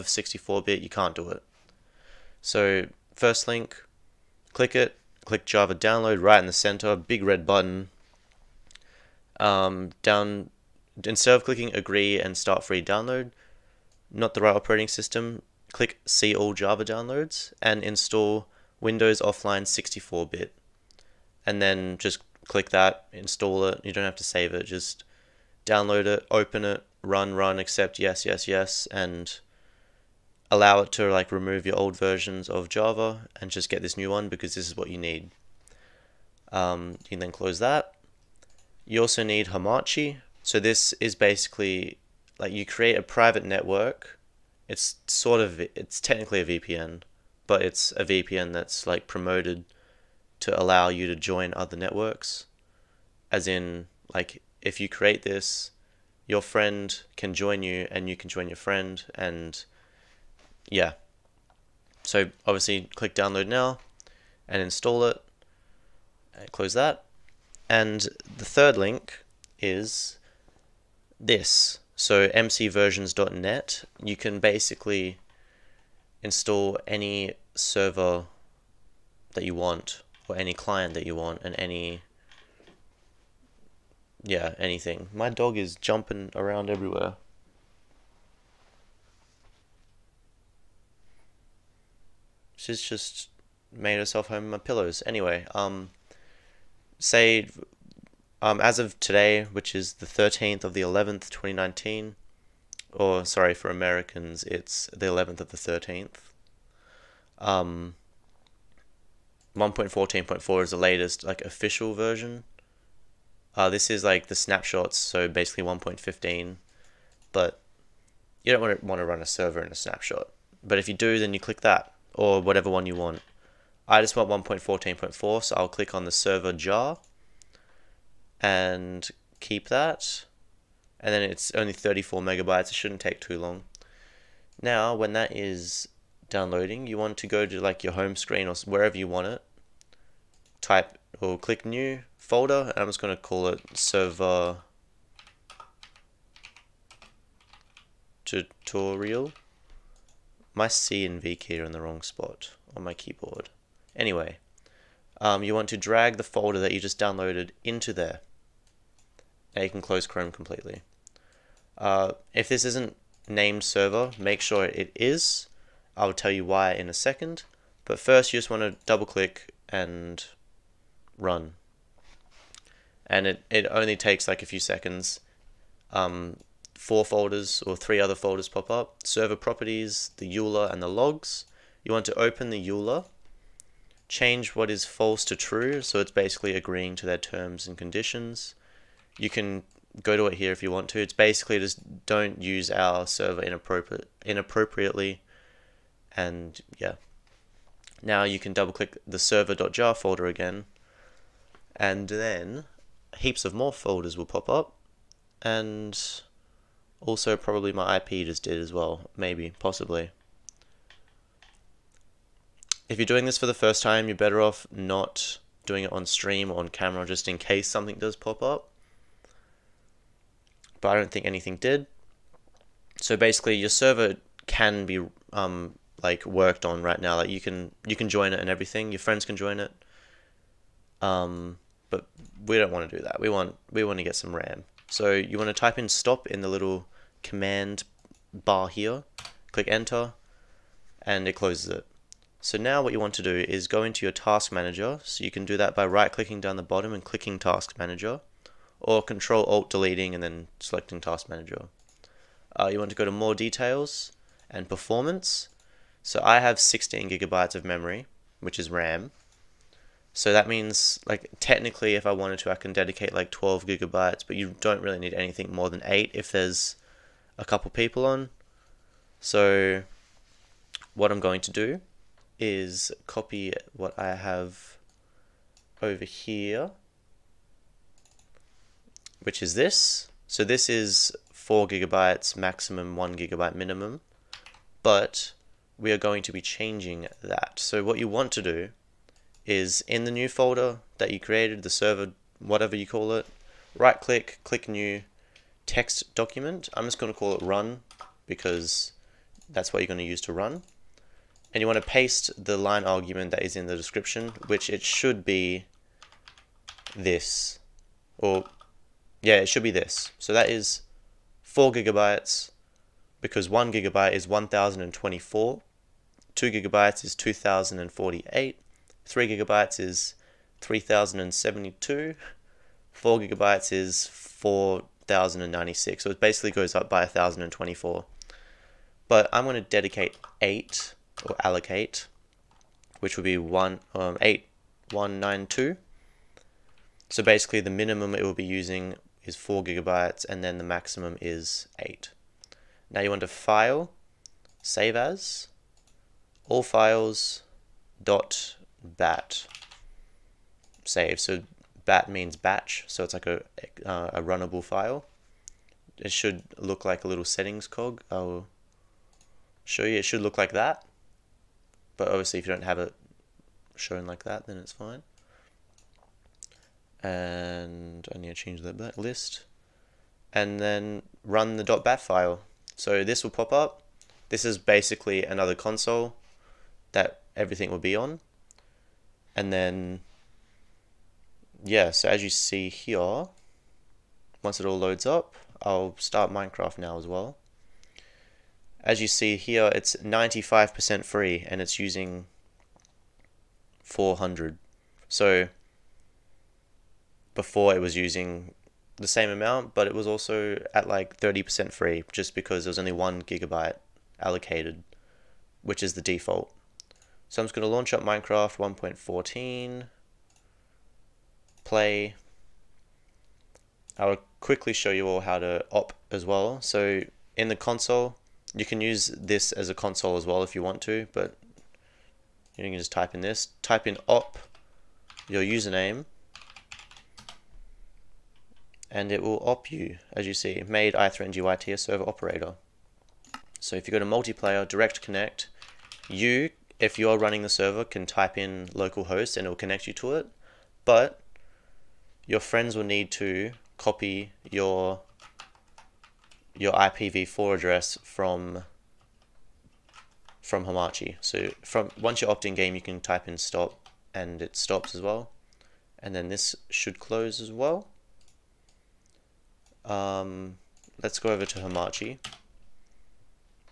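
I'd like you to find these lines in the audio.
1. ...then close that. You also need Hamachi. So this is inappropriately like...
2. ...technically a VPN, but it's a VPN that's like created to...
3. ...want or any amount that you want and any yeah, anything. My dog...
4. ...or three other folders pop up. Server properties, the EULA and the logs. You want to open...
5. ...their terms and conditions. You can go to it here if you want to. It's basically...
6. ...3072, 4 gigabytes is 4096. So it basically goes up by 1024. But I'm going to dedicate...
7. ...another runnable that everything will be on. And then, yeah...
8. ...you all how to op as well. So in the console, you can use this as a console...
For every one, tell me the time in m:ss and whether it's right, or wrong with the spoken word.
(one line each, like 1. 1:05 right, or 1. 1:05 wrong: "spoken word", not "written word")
1. 0:37 wrong: "basically", not "inappropriately"
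2. 0:45 wrong: "promoted", not "created"
3. 1:19 wrong: "client", not "amount"
4. 2:57 right
5. 3:07 right
6. 5:20 right
7. 6:15 wrong: "console", not "runnable"
8. 6:54 right.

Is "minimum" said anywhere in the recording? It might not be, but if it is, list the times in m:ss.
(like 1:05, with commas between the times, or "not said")
4:43, 5:37.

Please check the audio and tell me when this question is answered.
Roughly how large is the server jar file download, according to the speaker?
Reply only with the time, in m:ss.
2:11.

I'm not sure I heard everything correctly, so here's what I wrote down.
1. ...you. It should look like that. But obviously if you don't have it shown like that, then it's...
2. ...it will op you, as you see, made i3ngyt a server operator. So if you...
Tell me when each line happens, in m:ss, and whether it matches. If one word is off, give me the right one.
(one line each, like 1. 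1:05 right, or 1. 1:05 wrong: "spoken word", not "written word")
1. 5:59 right
2. 7:09 right.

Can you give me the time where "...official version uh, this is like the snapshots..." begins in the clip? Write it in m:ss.
1:51.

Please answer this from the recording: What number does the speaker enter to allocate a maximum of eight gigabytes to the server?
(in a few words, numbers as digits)
8192.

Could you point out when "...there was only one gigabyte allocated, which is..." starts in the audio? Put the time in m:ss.
6:42.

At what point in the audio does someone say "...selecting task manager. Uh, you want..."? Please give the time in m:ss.
4:10.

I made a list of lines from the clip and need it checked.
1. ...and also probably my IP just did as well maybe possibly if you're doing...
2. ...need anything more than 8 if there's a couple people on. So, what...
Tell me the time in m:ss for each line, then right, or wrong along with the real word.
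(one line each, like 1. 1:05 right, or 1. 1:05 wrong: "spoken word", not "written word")
1. 3:25 right
2. 4:24 right.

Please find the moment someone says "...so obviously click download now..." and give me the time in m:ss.
1:02.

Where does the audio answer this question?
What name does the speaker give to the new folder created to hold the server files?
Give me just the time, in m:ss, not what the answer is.
2:23.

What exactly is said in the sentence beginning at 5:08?
Or, yeah, it should be this.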